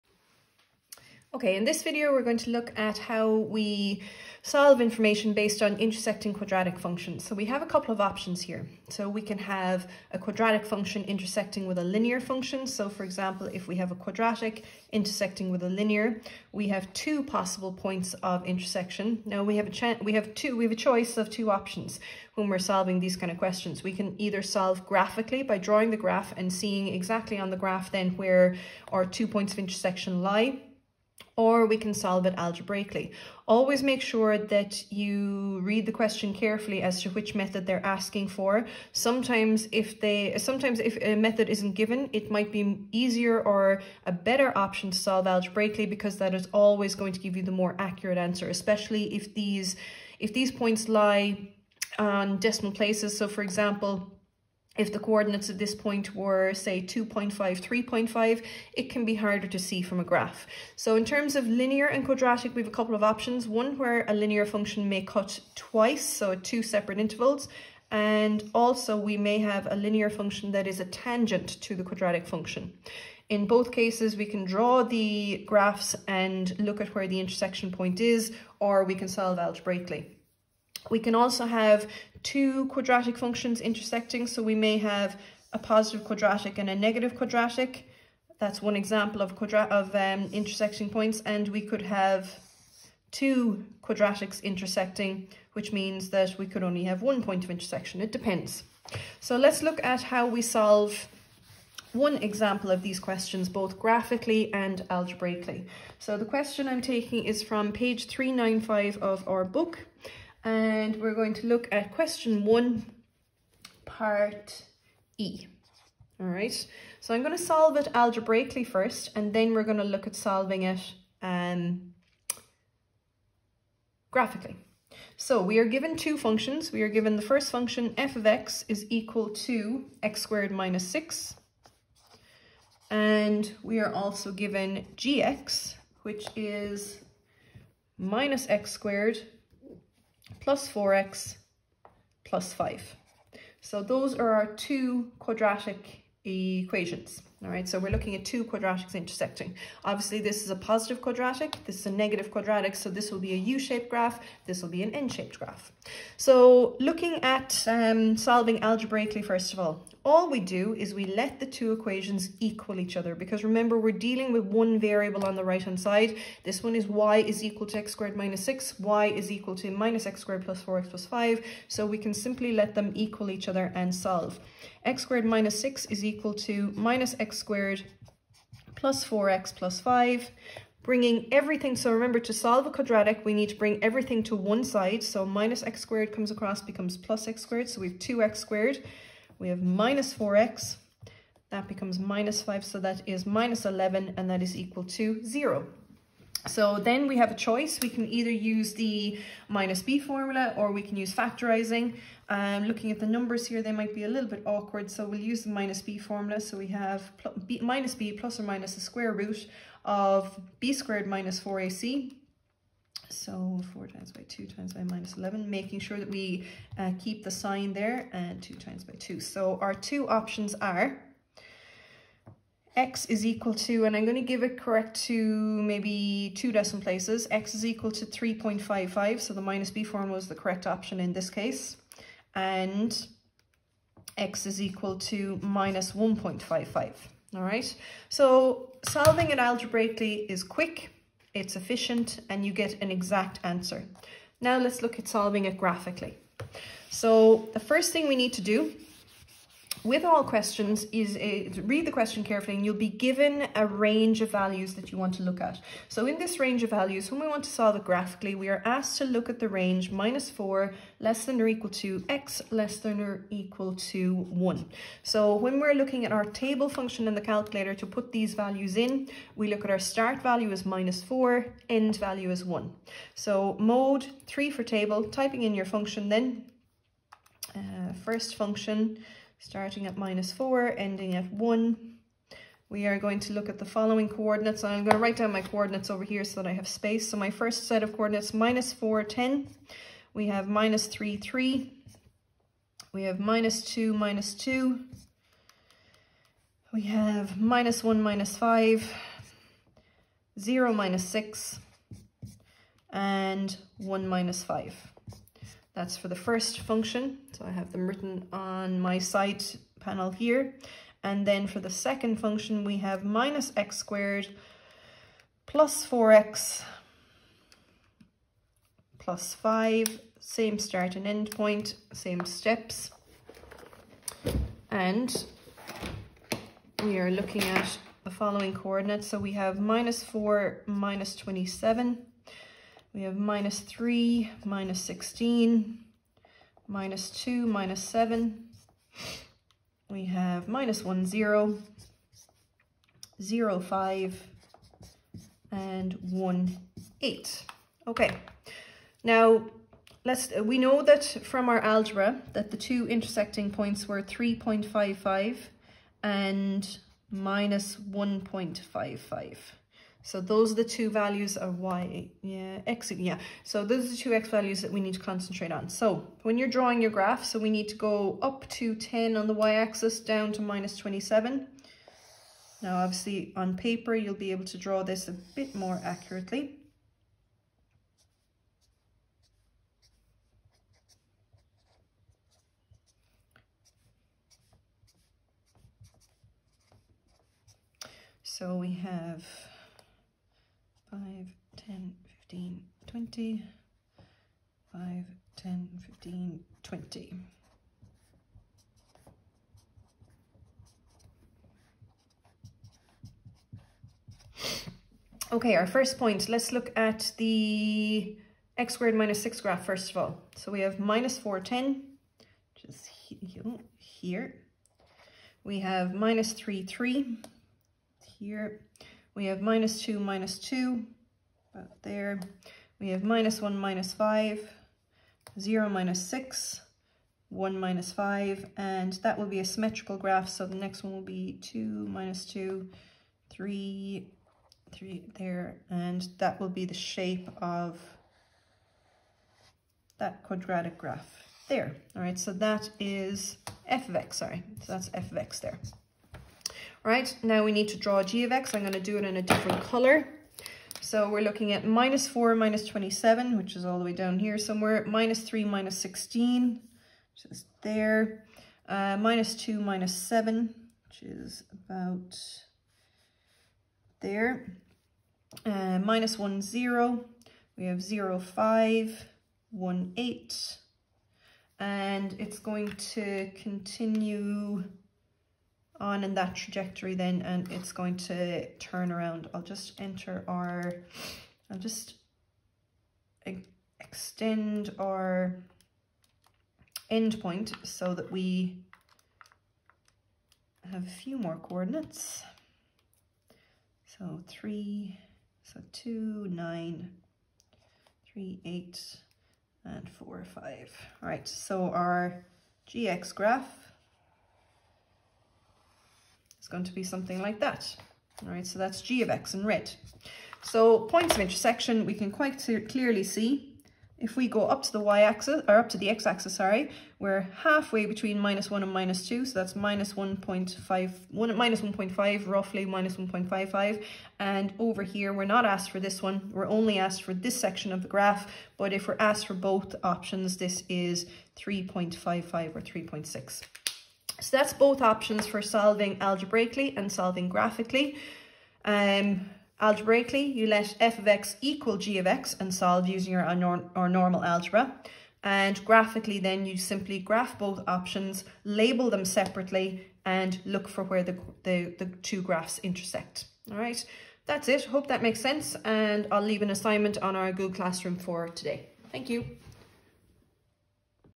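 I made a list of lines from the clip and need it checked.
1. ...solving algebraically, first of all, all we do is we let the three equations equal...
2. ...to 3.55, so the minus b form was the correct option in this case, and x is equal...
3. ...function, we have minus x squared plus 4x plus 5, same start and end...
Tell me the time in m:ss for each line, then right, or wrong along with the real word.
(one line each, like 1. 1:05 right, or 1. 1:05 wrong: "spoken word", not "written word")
1. 2:38 wrong: "two", not "three"
2. 3:47 right
3. 5:12 right.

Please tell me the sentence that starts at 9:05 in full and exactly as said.
And graphically, then you simply graph both options, label them separately, and look for where the, the, the two graphs intersect.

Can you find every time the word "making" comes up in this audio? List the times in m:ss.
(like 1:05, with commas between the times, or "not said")
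3:35.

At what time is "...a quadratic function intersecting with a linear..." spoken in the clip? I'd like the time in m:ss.
0:10.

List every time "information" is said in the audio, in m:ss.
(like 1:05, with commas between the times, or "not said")
0:04.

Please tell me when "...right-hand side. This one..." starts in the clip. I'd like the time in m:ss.
2:45.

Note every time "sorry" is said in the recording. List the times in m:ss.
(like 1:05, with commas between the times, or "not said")
7:24, 8:36.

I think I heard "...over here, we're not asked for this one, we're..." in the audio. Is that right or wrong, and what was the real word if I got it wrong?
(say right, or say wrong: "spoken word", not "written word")
right.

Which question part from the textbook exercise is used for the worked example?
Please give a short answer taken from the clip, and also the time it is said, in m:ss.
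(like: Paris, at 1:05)
Question 1 part E, at 1:51.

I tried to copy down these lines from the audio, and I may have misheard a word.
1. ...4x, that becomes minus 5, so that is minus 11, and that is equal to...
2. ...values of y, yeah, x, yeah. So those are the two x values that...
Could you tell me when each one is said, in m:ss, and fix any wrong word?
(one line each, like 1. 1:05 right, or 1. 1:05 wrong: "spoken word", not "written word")
1. 3:10 right
2. 6:00 right.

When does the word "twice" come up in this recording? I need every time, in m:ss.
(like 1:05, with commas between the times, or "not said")
1:05.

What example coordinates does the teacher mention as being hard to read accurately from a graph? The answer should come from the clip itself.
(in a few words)
2.5, 3.5.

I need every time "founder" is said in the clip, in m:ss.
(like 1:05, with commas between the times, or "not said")
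not said.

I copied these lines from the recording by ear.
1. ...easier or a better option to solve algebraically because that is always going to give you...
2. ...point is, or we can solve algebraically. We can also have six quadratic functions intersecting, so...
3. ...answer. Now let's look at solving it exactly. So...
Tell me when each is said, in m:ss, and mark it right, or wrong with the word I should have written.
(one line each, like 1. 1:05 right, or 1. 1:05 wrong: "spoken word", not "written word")
1. 0:42 right
2. 1:17 wrong: "two", not "six"
3. 4:03 wrong: "graphically", not "exactly".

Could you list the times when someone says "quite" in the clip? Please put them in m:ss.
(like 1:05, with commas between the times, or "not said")
8:32.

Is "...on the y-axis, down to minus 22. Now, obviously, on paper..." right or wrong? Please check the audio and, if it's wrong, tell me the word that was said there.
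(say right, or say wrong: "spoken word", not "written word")
wrong: "27", not "22".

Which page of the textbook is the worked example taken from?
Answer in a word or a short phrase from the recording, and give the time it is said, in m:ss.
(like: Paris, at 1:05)
395, at 1:47.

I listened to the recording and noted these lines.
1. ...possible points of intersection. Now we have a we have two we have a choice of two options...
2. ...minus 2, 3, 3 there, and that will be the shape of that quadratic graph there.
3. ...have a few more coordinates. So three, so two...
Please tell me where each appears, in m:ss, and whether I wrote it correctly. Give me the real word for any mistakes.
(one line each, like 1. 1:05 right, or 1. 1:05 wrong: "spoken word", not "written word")
1. 0:17 right
2. 7:11 right
3. 8:10 right.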